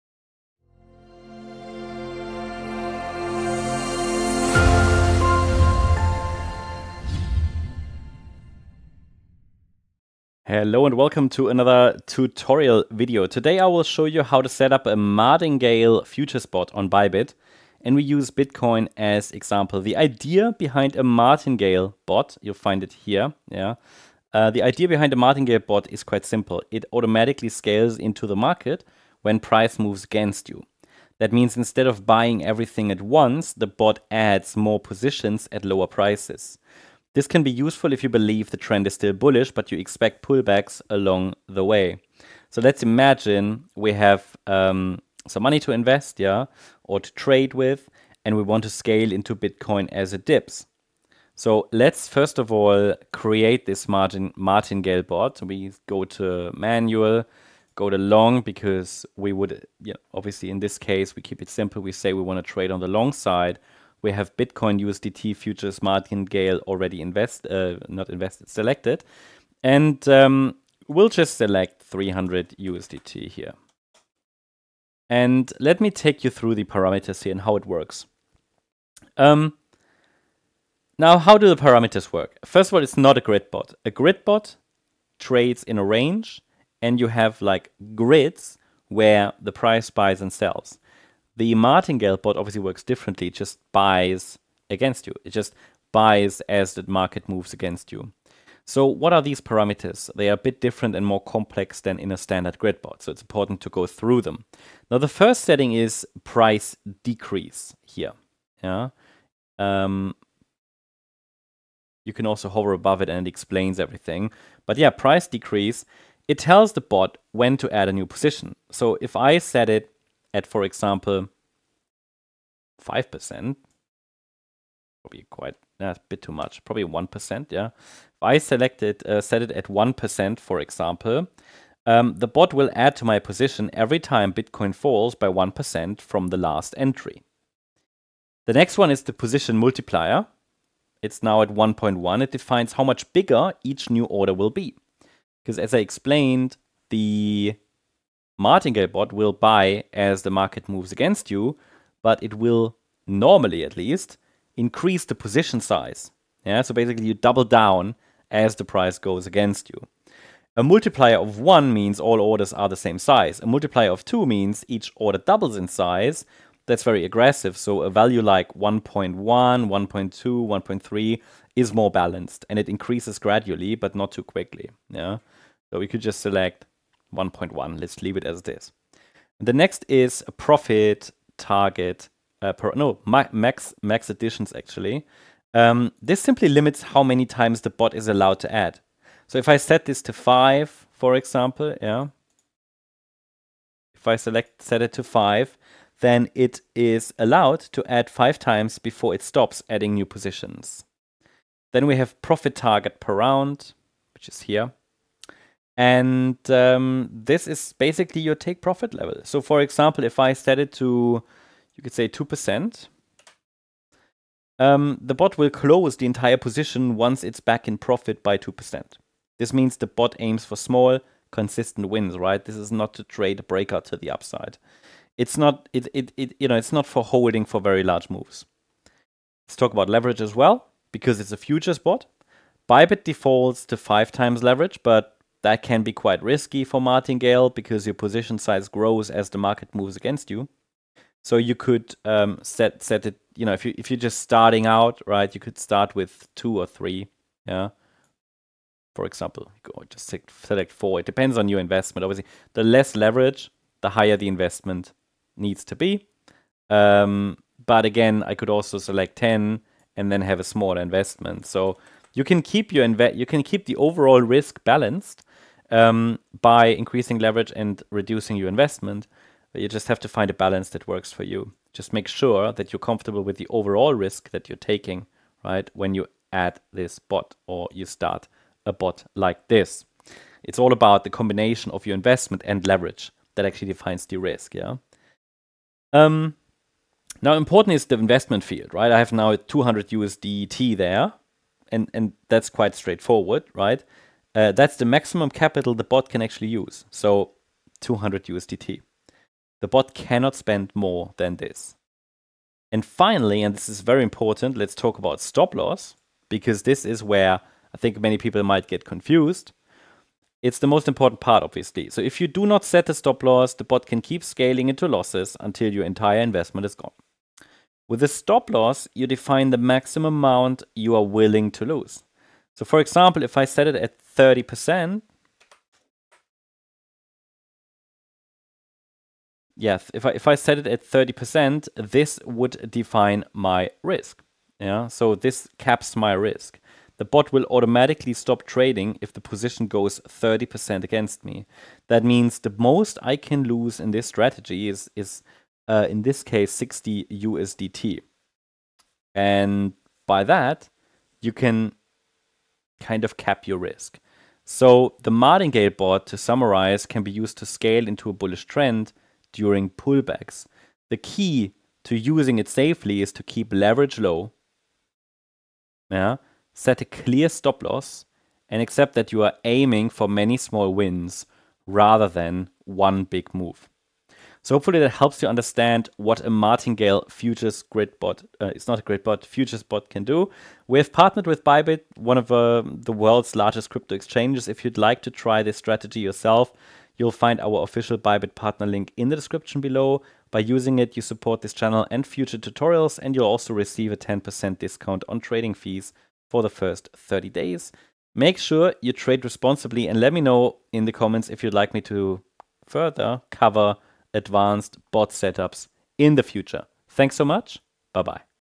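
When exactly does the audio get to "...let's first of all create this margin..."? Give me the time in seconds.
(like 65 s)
51 s.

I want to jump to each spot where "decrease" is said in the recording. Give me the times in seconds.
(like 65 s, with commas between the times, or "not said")
107 s, 115 s.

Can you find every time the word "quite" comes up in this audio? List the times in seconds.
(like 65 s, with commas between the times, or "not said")
26 s, 125 s, 235 s, 292 s.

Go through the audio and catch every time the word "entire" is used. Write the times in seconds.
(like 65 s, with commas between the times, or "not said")
216 s, 315 s.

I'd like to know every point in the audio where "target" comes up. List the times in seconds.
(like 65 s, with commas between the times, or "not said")
181 s, 202 s.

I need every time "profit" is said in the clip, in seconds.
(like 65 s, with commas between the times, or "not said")
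180 s, 202 s, 208 s, 217 s.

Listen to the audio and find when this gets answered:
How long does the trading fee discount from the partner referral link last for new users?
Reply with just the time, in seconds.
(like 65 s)
396 s.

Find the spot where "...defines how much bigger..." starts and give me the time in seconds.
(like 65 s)
142 s.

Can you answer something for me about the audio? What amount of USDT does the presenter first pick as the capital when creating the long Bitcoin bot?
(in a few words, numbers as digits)
300 USDT.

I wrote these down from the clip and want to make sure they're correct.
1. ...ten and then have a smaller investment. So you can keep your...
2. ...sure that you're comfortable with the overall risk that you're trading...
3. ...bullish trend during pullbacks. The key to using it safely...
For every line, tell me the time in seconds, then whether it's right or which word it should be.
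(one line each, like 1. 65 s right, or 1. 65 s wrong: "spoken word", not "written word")
1. 259 s right
2. 272 s wrong: "taking", not "trading"
3. 358 s right.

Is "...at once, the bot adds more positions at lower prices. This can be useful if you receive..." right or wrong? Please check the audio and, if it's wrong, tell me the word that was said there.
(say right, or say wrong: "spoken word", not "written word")
wrong: "believe", not "receive".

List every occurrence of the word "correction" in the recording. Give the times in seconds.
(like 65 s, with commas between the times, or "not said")
not said.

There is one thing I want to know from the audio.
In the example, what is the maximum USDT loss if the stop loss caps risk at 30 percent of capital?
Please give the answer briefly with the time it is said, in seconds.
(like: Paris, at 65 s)
60 USDT, at 346 s.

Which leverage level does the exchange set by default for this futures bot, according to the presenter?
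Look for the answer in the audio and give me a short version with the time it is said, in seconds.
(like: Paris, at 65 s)
5x, at 233 s.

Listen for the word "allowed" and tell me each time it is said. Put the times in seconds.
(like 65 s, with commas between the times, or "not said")
188 s, 197 s.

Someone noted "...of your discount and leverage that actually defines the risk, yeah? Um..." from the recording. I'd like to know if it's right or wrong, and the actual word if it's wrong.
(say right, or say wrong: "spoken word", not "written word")
wrong: "investment", not "discount".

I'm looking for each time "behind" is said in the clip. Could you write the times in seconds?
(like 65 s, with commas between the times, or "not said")
20 s, 24 s.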